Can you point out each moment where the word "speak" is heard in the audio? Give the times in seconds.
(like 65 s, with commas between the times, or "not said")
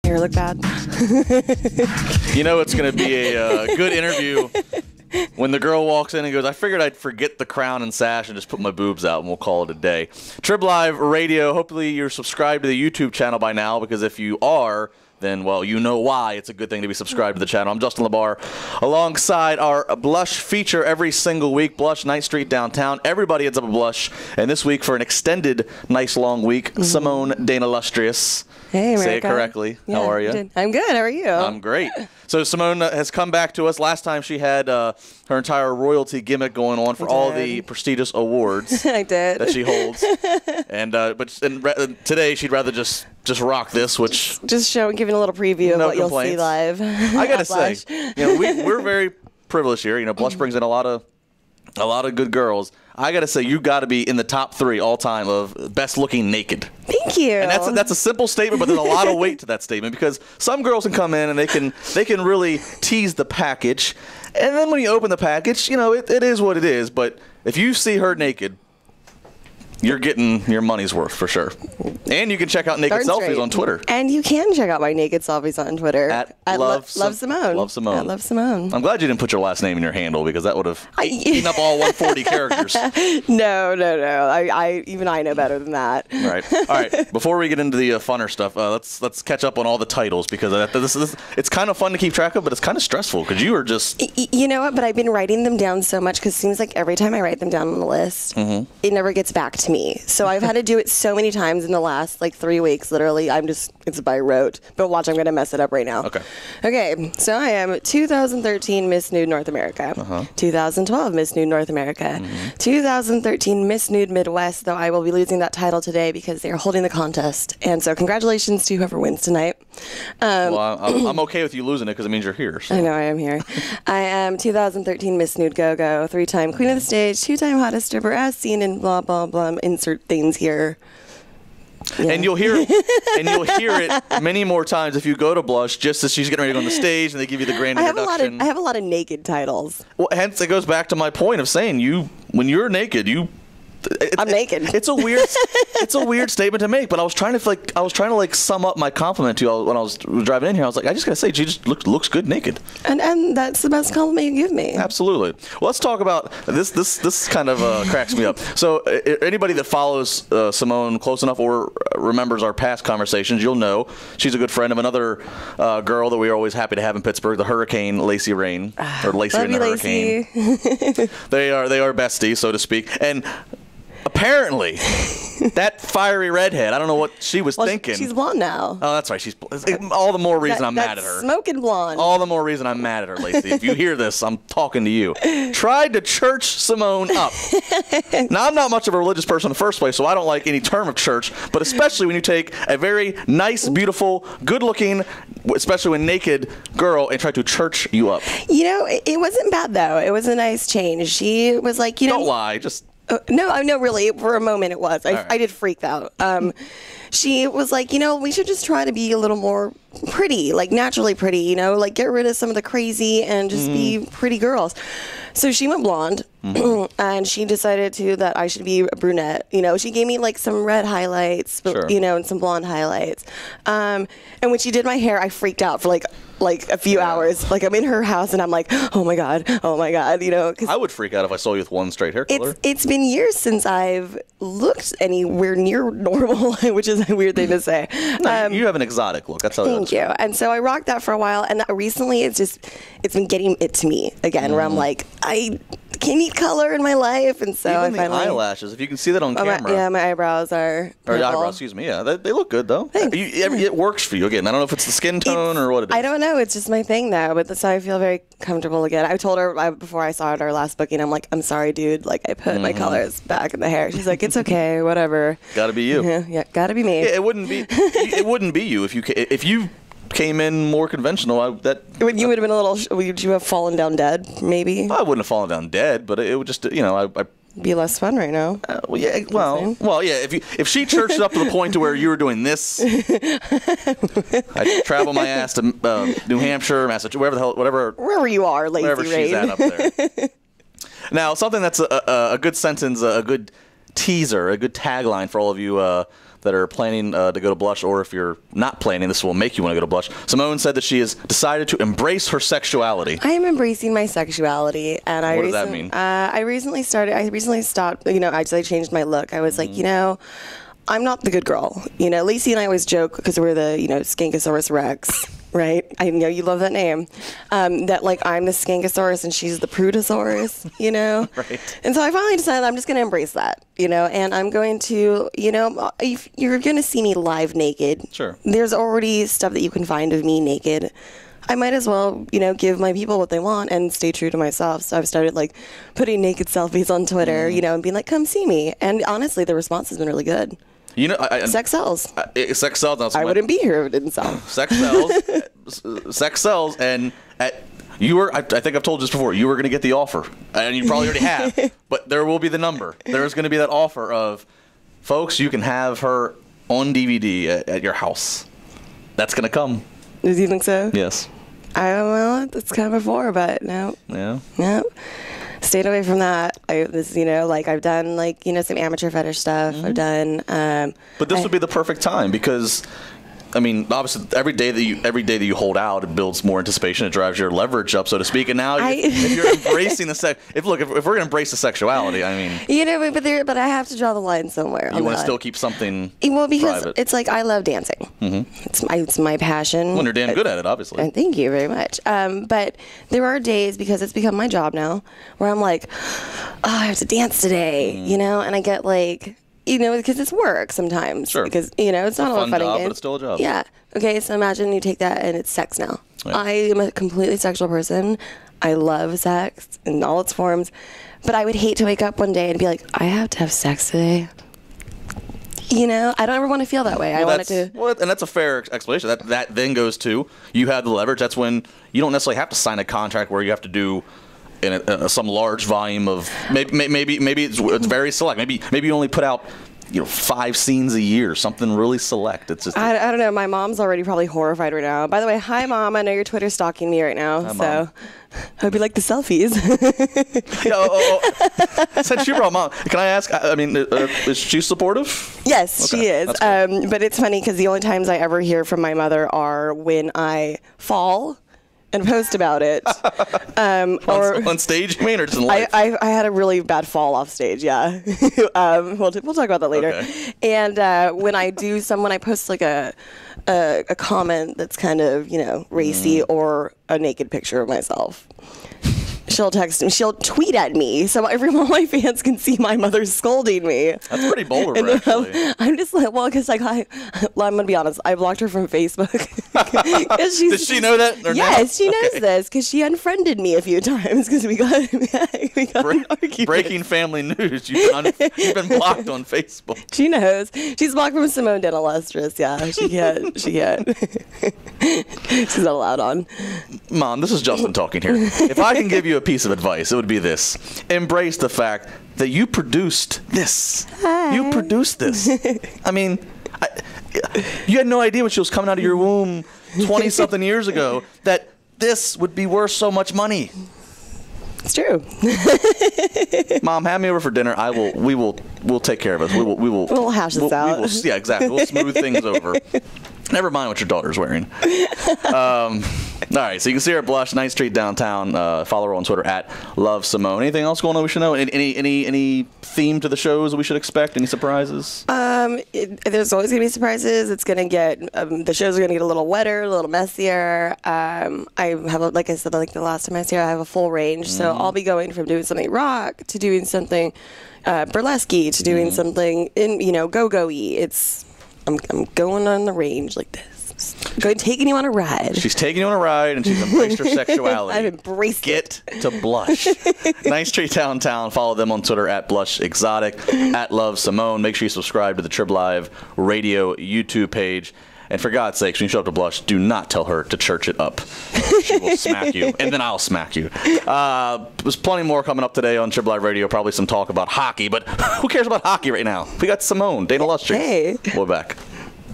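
172 s, 378 s.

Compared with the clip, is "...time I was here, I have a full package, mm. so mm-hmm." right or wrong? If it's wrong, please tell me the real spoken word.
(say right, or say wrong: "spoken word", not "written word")
wrong: "range", not "package".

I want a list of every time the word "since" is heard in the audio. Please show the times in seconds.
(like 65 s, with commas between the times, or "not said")
233 s, 442 s.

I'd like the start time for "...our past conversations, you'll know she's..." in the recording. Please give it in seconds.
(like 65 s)
162 s.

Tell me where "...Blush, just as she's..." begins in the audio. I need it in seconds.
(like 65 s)
135 s.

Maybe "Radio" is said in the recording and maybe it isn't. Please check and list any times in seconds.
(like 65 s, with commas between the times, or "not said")
10 s, 566 s, 576 s.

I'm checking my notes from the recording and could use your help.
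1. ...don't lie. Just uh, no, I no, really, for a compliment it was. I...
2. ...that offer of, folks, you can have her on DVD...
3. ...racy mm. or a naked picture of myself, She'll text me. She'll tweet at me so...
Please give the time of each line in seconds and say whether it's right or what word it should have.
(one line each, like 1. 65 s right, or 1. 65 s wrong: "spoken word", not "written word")
1. 202 s wrong: "moment", not "compliment"
2. 353 s right
3. 465 s right.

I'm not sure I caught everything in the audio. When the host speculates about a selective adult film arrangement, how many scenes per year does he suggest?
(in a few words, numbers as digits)
5.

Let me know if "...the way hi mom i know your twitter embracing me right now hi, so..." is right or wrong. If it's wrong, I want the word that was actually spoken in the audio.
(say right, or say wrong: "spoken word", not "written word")
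wrong: "stalking", not "embracing".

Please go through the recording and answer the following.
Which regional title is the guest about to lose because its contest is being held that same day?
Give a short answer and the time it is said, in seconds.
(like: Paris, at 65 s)
Miss Nude Midwest, at 113 s.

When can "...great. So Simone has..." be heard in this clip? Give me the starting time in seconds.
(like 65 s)
31 s.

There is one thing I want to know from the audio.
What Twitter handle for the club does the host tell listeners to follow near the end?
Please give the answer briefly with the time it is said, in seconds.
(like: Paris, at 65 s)
Blush Exotic, at 562 s.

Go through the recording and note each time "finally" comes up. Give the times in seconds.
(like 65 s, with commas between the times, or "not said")
247 s, 322 s.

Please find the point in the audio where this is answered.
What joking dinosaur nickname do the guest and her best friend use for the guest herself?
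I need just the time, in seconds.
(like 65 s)
314 s.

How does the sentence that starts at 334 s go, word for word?
So I've started like putting naked selfies on Twitter, mm you know, and being like, come see me.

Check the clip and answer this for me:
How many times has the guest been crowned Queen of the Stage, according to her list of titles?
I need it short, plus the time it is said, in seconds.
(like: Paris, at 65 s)
3, at 126 s.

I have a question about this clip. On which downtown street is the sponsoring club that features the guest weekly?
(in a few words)
Ninth Street.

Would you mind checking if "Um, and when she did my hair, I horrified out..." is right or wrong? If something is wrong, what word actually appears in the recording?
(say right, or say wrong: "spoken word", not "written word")
wrong: "freaked", not "horrified".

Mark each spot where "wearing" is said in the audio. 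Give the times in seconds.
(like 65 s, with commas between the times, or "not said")
524 s.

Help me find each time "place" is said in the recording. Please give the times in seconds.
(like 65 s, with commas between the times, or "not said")
189 s.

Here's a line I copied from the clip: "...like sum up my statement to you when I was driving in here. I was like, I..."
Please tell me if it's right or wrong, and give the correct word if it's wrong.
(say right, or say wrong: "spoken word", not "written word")
wrong: "compliment", not "statement".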